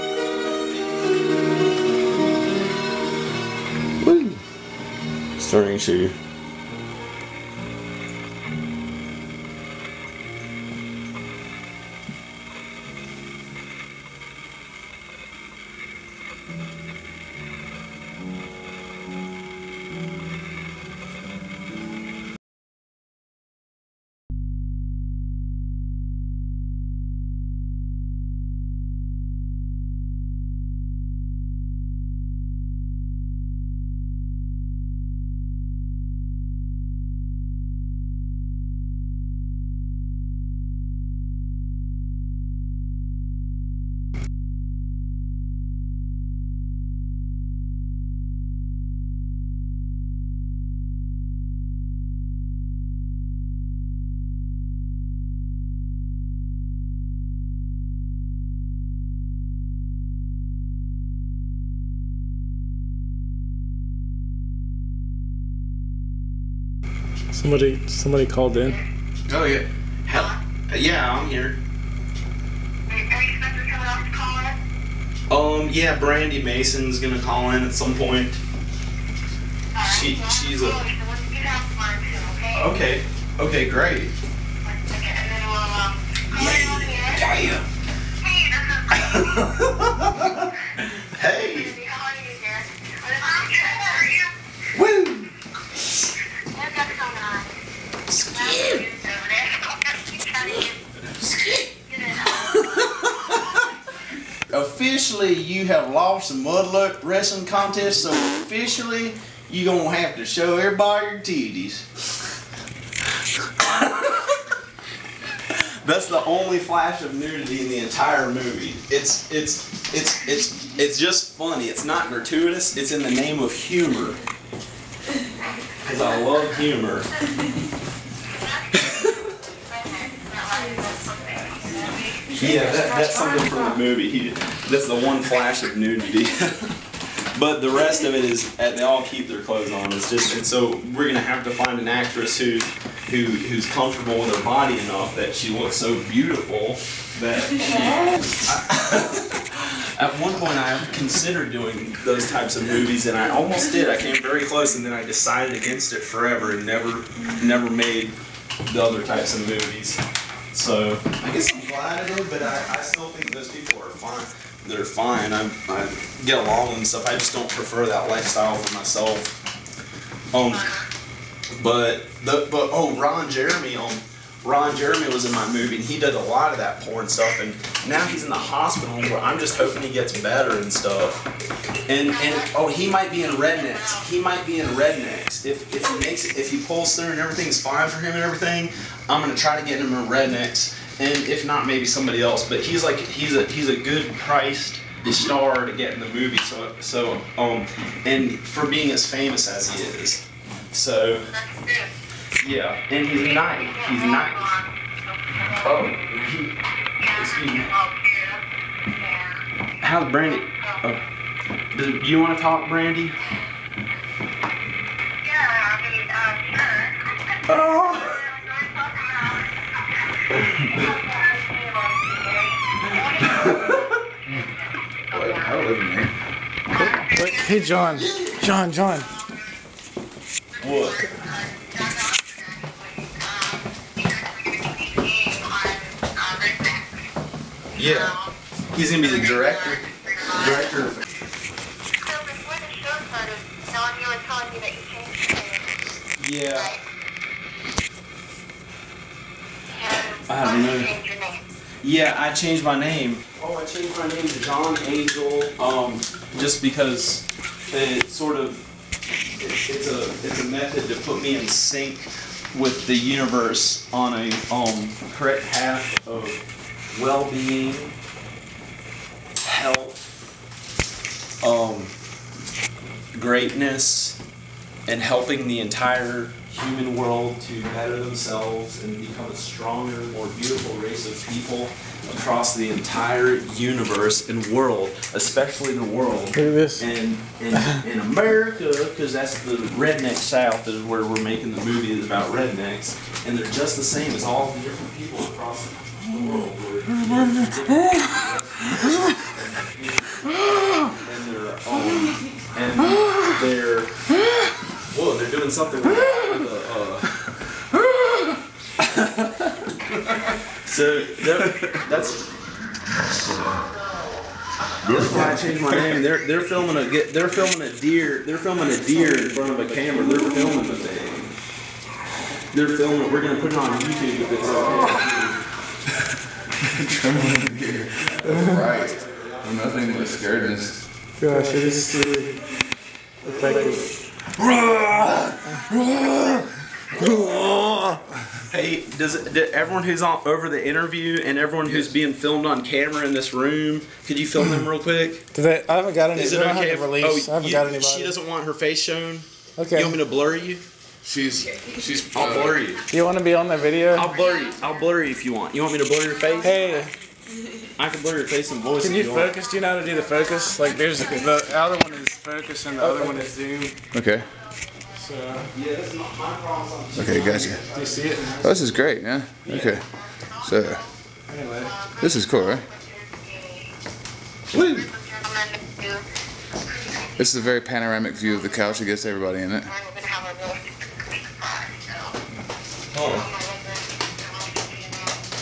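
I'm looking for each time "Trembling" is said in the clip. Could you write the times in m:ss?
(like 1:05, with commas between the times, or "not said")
5:26.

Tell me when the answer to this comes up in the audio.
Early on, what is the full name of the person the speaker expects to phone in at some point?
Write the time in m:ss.
1:15.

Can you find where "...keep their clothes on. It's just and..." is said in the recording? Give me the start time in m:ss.
2:19.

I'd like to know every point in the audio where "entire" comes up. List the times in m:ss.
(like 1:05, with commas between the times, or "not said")
1:57, 4:35, 4:42.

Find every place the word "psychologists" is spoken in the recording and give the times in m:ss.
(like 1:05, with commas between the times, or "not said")
not said.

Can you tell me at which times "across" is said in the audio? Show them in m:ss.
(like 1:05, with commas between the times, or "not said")
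4:42, 4:55.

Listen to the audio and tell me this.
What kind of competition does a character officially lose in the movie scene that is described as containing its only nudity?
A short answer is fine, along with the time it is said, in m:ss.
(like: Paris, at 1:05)
mudluck wrestling contest, at 1:46.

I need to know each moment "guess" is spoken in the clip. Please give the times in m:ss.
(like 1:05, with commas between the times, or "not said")
2:41.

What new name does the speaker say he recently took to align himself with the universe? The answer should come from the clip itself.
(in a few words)
John Angel.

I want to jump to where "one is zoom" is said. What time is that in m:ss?
6:03.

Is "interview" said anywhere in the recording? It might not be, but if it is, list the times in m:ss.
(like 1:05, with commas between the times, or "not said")
5:40.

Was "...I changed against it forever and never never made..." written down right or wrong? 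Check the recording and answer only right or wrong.
wrong.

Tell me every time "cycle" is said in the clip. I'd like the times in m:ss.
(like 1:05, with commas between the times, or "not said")
not said.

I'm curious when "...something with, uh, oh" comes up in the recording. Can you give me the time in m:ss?
5:05.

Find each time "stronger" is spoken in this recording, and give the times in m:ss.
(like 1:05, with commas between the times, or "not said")
4:39.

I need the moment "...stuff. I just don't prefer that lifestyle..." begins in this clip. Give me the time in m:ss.
2:46.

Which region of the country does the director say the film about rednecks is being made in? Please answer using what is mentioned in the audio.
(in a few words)
the redneck South.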